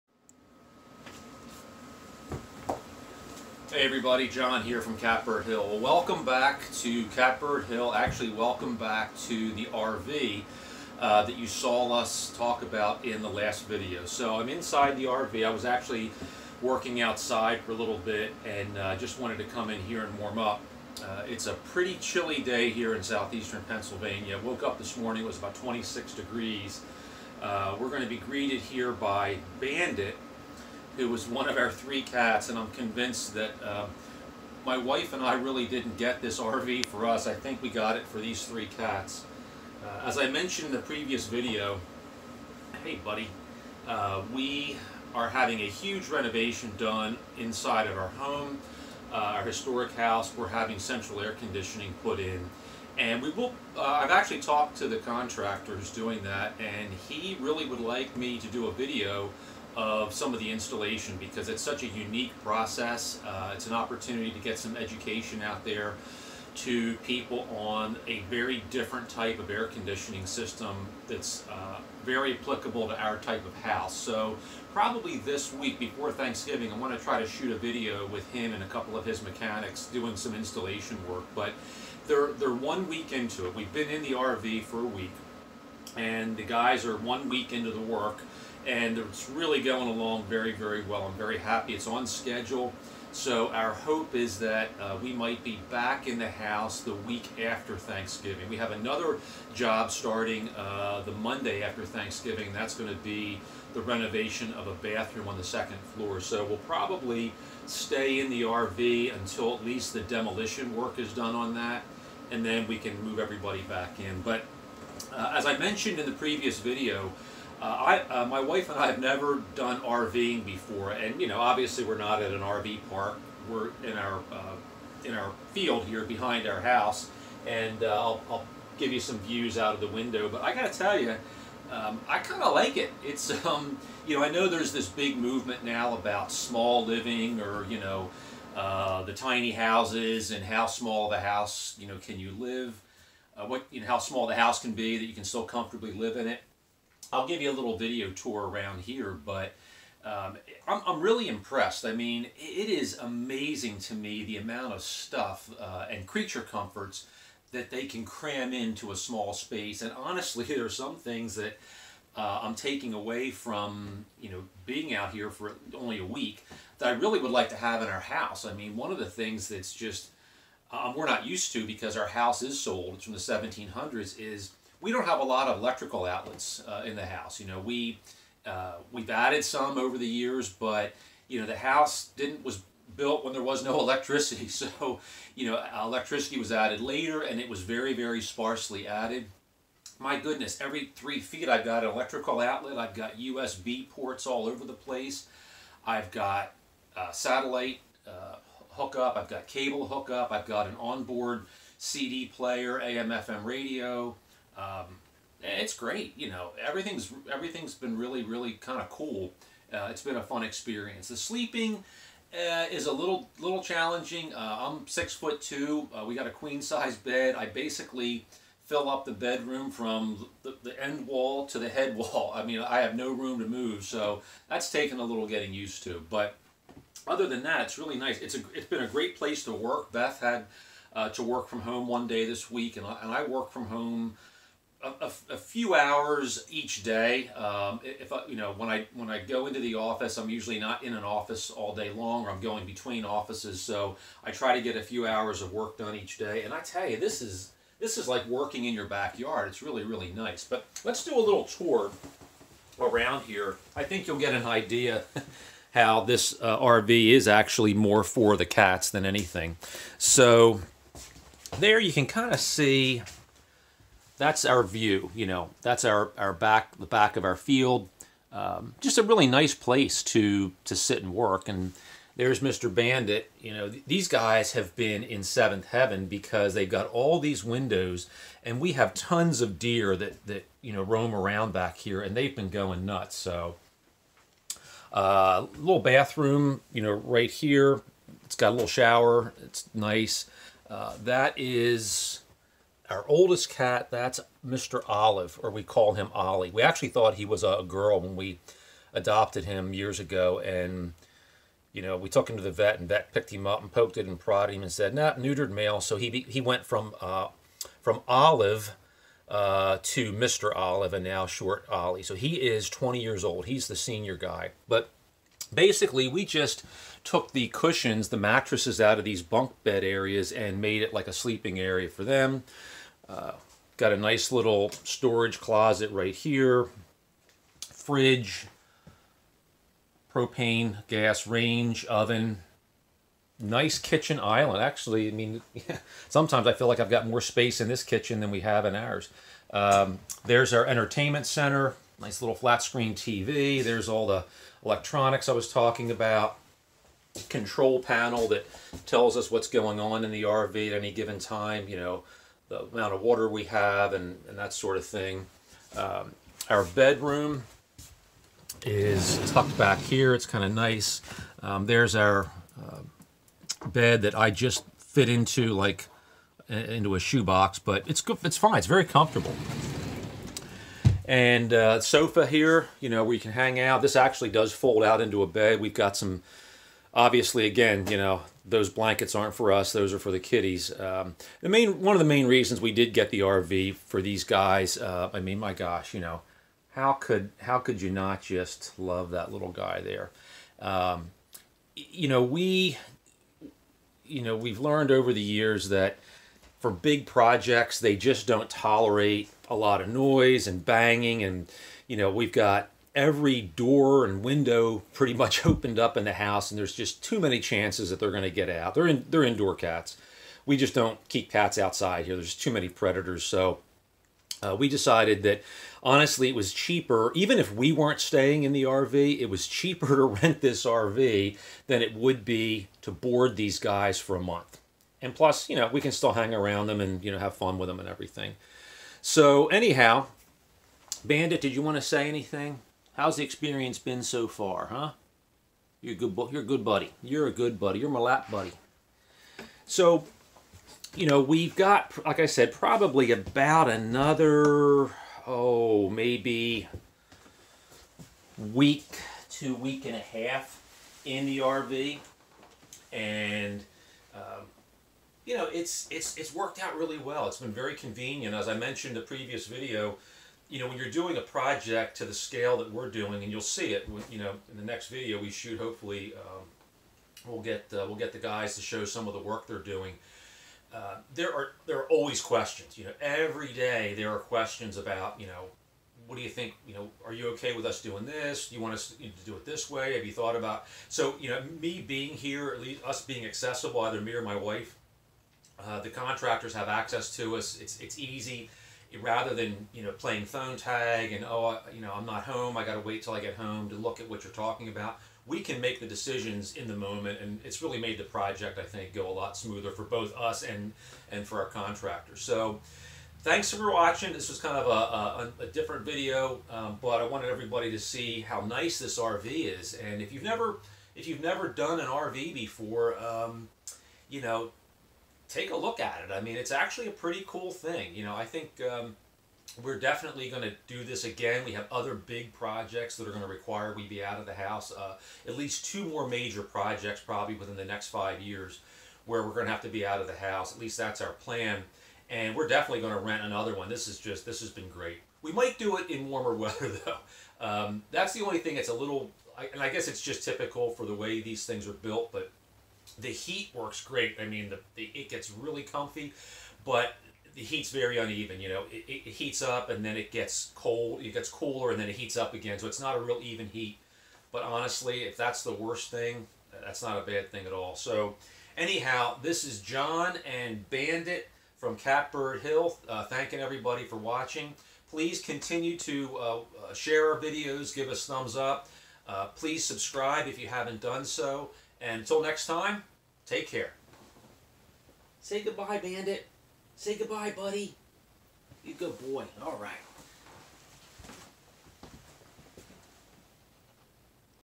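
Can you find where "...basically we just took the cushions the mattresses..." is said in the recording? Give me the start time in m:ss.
5:15.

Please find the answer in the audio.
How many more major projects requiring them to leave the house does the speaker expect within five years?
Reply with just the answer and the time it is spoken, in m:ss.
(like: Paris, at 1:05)
2, at 8:45.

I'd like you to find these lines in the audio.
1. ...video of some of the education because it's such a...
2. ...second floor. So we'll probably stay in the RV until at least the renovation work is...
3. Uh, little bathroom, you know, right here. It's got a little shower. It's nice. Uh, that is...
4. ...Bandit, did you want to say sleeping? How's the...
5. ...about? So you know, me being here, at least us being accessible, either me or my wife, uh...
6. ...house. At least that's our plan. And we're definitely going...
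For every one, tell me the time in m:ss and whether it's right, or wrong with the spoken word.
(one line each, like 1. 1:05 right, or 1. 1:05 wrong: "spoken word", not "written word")
1. 0:58 wrong: "installation", not "education"
2. 1:45 wrong: "demolition", not "renovation"
3. 4:44 right
4. 7:11 wrong: "anything", not "sleeping"
5. 8:00 right
6. 8:50 right.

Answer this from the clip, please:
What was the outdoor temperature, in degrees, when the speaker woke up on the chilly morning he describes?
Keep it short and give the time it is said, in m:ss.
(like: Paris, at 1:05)
26, at 0:25.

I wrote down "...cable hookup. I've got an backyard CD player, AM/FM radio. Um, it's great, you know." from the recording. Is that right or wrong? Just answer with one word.
wrong.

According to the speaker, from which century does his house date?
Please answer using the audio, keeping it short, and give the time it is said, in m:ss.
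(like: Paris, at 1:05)
1700s, at 2:53.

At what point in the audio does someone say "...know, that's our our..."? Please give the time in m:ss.
4:25.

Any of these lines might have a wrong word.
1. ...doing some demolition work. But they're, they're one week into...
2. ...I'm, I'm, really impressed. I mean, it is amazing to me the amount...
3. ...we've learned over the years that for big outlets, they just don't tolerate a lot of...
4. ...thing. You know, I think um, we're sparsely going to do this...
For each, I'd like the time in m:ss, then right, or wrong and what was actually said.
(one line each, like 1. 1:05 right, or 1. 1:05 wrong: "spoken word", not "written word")
1. 1:19 wrong: "installation", not "demolition"
2. 2:30 right
3. 6:34 wrong: "projects", not "outlets"
4. 8:37 wrong: "definitely", not "sparsely".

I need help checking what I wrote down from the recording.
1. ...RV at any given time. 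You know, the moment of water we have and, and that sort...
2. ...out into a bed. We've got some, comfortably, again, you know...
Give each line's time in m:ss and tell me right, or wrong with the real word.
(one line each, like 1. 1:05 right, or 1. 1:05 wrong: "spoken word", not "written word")
1. 5:50 wrong: "amount", not "moment"
2. 6:14 wrong: "obviously", not "comfortably".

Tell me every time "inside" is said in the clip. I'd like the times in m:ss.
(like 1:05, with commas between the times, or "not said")
0:14, 0:47.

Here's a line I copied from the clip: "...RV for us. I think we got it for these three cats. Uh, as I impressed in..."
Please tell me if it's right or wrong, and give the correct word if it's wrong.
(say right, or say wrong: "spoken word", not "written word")
wrong: "mentioned", not "impressed".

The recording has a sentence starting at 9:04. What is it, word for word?
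I mean, the, the it gets really comfy, but the heat's very uneven.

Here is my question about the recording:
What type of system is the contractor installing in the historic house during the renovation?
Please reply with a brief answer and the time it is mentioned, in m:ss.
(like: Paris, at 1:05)
Central air conditioning, at 0:50.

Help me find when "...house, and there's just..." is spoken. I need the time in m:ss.
6:46.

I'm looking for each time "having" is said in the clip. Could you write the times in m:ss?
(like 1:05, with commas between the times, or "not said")
0:45, 0:50.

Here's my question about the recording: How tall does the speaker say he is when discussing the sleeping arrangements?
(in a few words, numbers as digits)
6 foot 2.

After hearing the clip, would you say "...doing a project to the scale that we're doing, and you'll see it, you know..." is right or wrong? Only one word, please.
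right.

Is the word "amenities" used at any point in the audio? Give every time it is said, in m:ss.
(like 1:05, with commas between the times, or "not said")
not said.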